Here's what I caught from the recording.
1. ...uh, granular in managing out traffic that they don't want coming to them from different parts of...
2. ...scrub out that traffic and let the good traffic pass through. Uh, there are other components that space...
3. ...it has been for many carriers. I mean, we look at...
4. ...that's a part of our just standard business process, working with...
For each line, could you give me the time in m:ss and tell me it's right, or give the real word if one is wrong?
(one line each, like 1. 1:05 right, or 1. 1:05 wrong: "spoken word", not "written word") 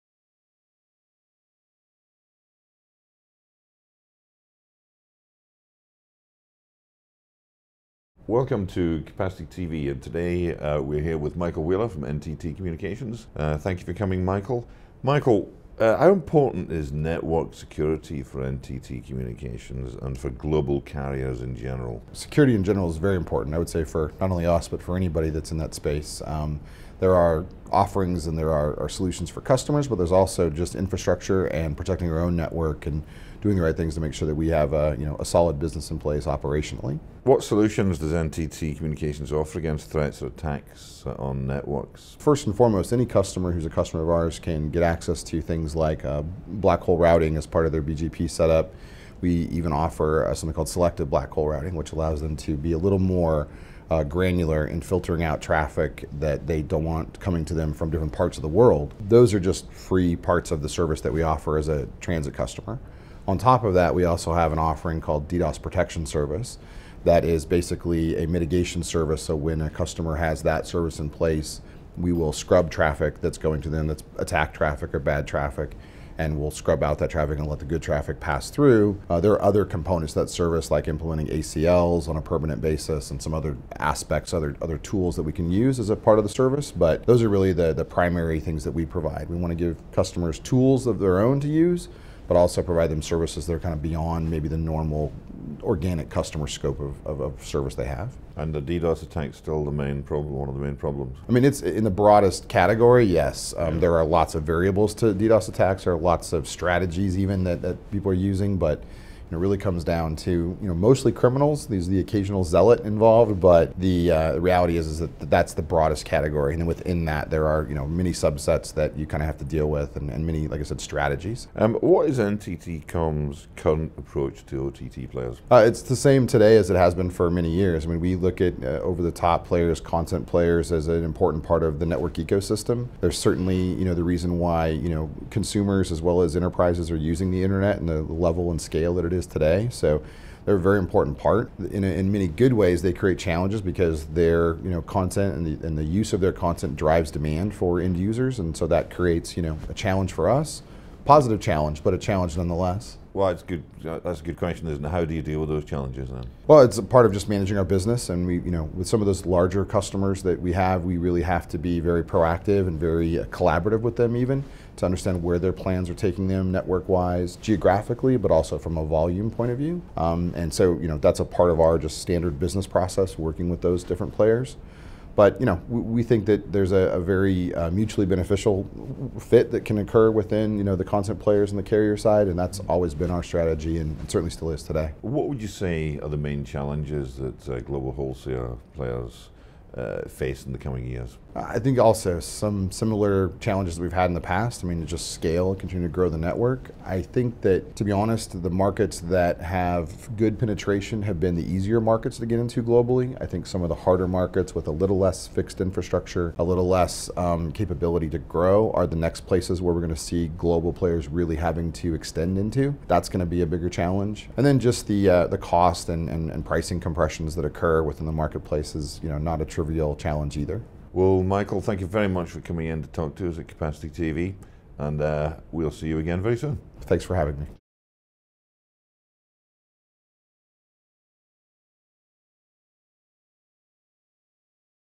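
1. 0:53 wrong: "filtering", not "managing"
2. 1:16 wrong: "service", not "space"
3. 2:06 wrong: "years", not "carriers"
4. 2:50 right.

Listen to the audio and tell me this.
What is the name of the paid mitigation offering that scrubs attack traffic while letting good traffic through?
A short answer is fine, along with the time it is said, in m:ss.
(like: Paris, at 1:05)
DDoS Protection Service, at 1:05.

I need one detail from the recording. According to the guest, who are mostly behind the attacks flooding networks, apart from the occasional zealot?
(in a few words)
criminals.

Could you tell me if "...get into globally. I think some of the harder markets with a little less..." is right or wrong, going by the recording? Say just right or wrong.
right.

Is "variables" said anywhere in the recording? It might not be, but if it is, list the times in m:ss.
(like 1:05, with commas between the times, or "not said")
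1:44.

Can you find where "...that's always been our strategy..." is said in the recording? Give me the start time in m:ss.
3:02.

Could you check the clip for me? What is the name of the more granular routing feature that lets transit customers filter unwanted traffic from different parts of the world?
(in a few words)
selective black hole routing.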